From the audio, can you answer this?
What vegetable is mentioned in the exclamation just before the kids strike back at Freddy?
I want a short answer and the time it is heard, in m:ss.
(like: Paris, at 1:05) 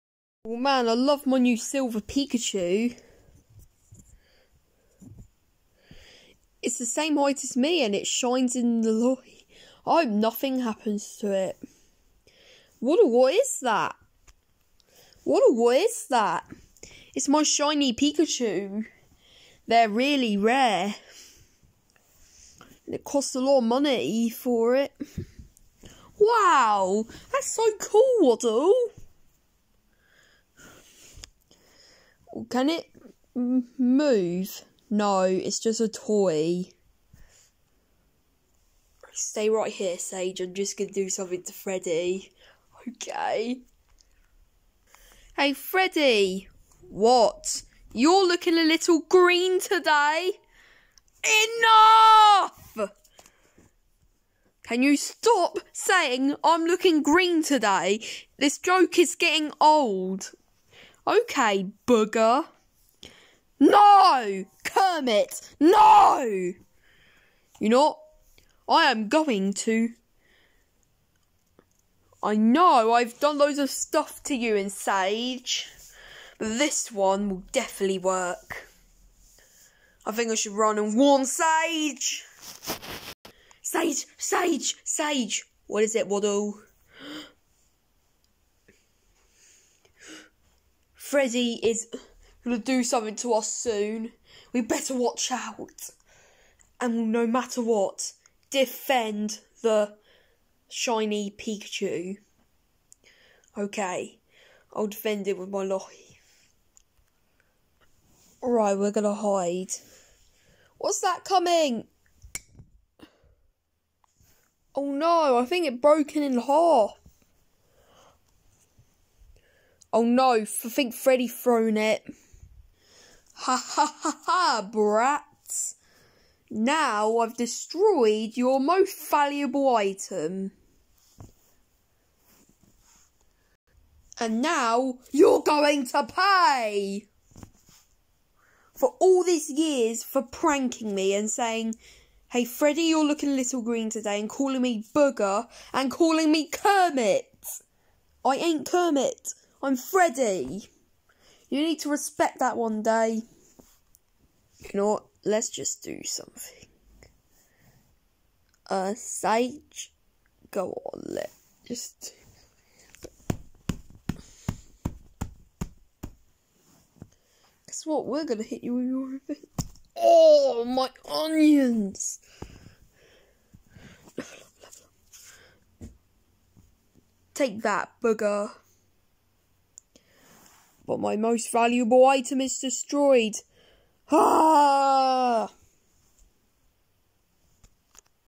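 Onions, at 2:51.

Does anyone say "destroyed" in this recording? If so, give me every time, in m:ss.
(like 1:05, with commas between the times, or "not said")
2:07, 3:02.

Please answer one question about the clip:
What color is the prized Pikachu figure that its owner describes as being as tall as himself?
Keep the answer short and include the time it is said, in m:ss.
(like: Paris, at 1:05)
Silver, at 0:01.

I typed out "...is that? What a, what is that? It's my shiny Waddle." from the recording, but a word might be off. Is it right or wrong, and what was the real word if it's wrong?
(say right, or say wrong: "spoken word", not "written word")
wrong: "Pikachu", not "Waddle".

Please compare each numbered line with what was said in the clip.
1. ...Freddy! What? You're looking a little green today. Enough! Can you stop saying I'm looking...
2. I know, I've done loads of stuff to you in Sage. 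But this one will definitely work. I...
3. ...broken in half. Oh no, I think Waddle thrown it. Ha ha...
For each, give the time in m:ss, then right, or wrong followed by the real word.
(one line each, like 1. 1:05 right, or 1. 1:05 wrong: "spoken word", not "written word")
1. 0:45 right
2. 1:12 right
3. 1:55 wrong: "Freddy", not "Waddle".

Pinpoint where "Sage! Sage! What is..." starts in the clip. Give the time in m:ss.
1:24.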